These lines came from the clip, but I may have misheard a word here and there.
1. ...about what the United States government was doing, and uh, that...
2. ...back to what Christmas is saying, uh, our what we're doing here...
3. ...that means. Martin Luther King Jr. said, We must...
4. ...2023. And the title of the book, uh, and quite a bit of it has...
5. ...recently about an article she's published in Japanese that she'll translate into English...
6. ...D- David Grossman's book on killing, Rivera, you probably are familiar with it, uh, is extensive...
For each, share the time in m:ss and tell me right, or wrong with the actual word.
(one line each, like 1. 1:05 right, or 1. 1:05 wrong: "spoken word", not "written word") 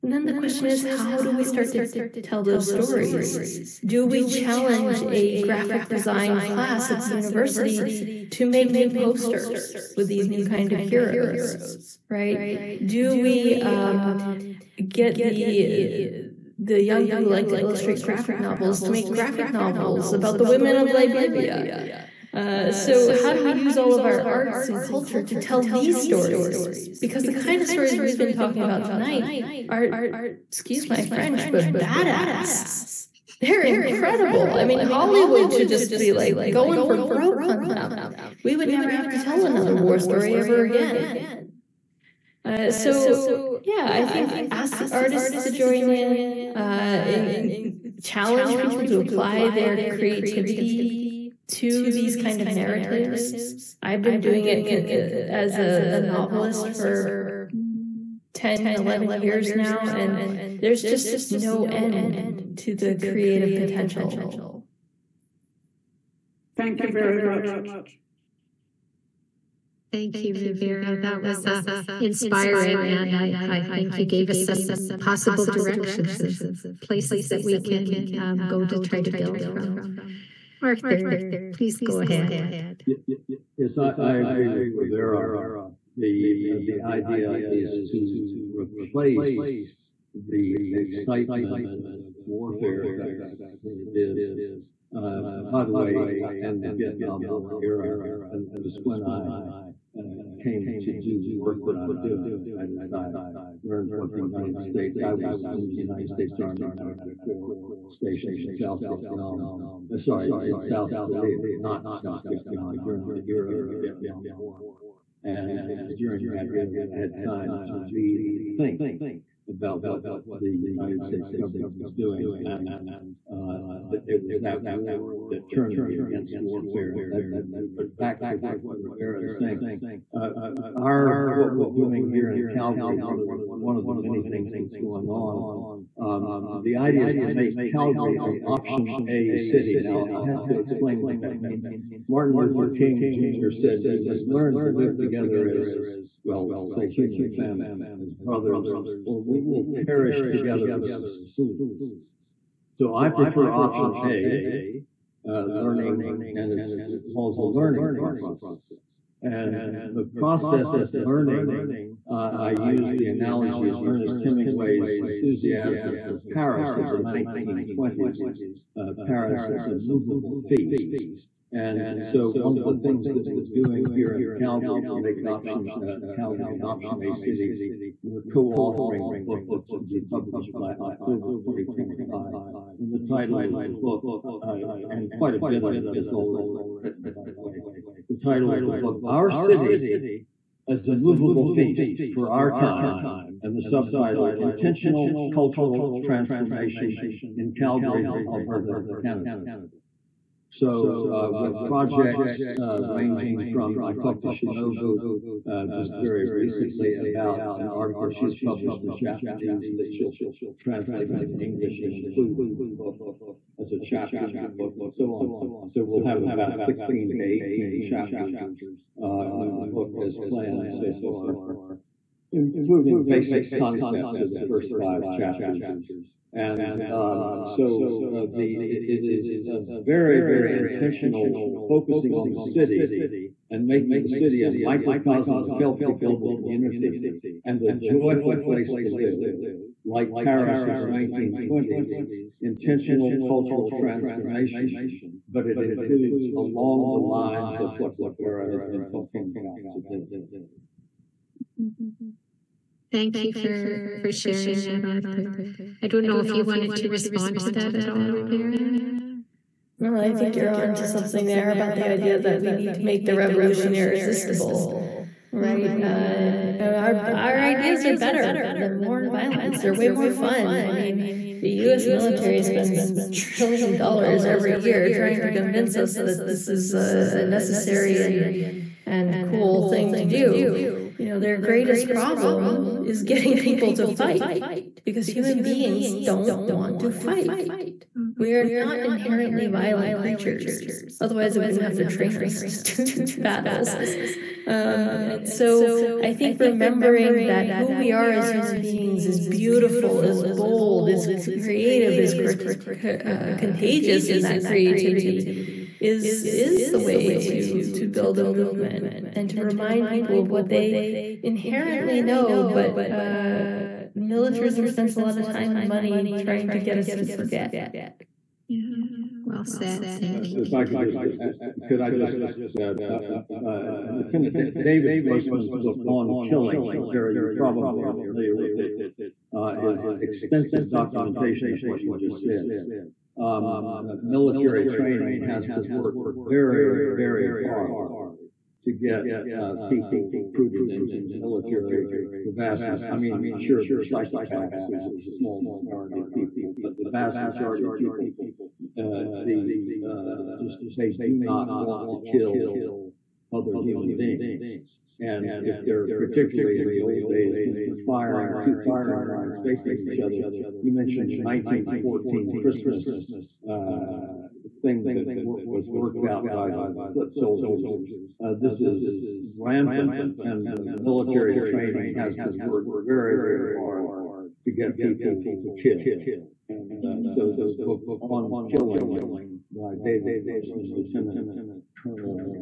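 1. 1:59 right
2. 2:07 wrong: "Rivera", not "Christmas"
3. 2:21 right
4. 3:01 wrong: "2025", not "2023"
5. 3:26 right
6. 5:24 right.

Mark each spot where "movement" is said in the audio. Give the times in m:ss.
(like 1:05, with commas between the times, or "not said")
5:08.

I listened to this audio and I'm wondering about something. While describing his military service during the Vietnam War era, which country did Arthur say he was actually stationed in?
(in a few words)
South Korea.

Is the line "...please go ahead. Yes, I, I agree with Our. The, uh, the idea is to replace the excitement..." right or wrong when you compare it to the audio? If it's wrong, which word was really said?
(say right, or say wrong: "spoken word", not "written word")
wrong: "Rivera", not "Our".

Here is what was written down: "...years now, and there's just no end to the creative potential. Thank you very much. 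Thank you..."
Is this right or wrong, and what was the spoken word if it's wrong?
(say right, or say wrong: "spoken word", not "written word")
right.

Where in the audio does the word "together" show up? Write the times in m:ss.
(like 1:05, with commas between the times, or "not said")
2:24, 2:30.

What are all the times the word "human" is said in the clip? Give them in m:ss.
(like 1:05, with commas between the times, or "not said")
2:26, 4:45, 4:58, 5:53.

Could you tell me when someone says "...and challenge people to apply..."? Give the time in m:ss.
0:46.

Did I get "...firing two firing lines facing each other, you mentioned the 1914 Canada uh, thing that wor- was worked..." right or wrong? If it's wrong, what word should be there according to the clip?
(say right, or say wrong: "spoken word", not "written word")
wrong: "Christmas", not "Canada".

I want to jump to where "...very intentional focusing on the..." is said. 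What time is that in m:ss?
3:50.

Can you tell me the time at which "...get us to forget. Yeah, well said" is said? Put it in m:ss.
5:16.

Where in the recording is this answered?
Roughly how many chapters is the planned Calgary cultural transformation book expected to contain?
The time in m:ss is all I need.
3:36.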